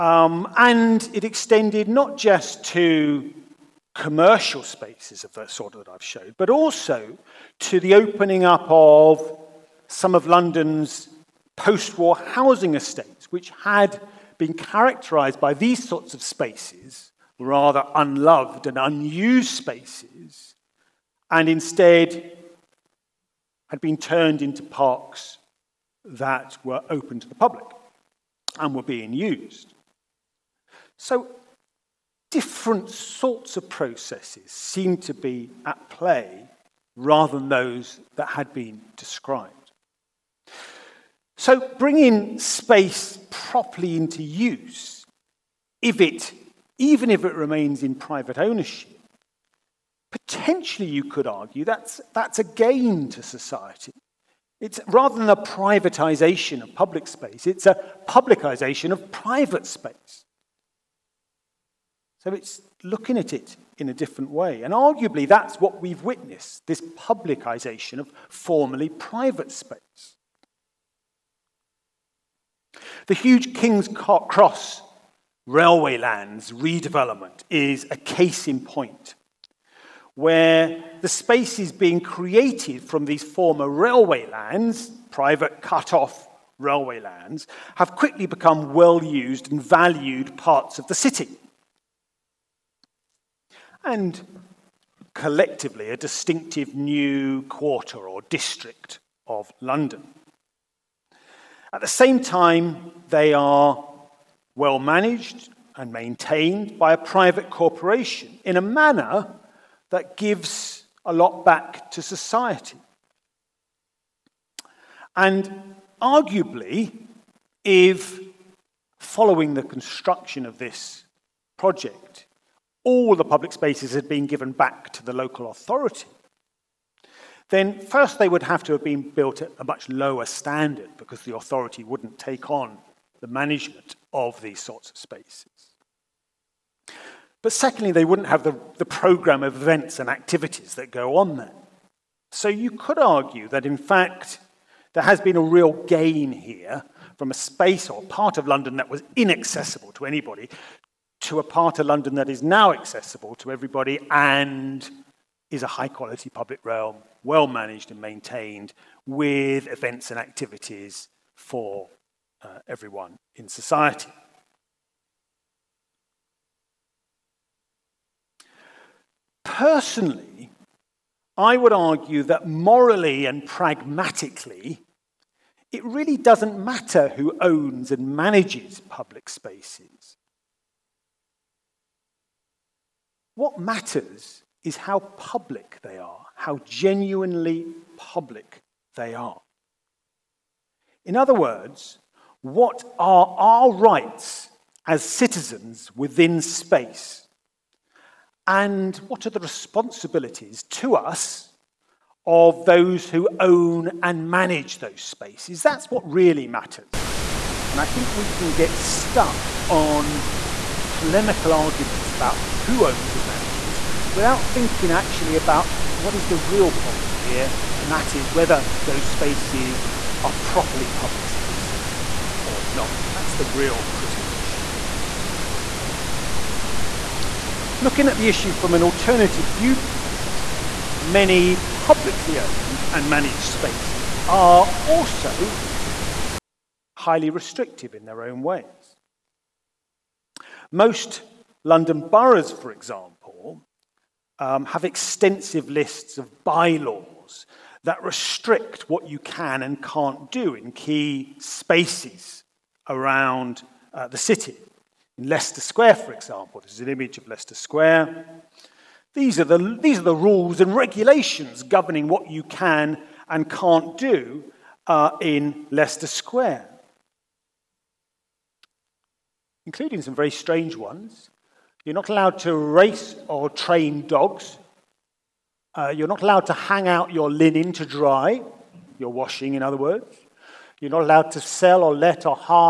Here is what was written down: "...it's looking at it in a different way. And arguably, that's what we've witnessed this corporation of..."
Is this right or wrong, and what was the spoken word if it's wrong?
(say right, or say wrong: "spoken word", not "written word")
wrong: "publicization", not "corporation".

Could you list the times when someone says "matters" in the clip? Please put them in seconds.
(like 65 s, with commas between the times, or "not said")
176 s, 183 s, 206 s.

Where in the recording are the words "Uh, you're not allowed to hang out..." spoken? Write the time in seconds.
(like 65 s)
275 s.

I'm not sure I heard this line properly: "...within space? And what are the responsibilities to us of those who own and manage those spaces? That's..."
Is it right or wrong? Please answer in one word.
right.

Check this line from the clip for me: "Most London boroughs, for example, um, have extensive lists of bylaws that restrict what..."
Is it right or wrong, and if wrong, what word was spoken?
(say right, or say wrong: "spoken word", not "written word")
right.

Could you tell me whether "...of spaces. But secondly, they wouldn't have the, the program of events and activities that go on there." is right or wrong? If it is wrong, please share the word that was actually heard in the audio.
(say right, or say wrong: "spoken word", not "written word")
right.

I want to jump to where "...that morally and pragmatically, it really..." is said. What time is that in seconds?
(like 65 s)
172 s.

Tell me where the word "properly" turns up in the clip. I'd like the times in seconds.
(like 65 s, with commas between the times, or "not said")
43 s, 220 s.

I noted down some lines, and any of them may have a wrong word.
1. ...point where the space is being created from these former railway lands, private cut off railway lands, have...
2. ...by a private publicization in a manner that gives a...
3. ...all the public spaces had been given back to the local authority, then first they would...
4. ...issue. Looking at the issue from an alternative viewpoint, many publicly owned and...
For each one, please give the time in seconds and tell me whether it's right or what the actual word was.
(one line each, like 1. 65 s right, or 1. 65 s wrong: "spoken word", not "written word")
1. 78 s right
2. 106 s wrong: "corporation", not "publicization"
3. 122 s right
4. 224 s right.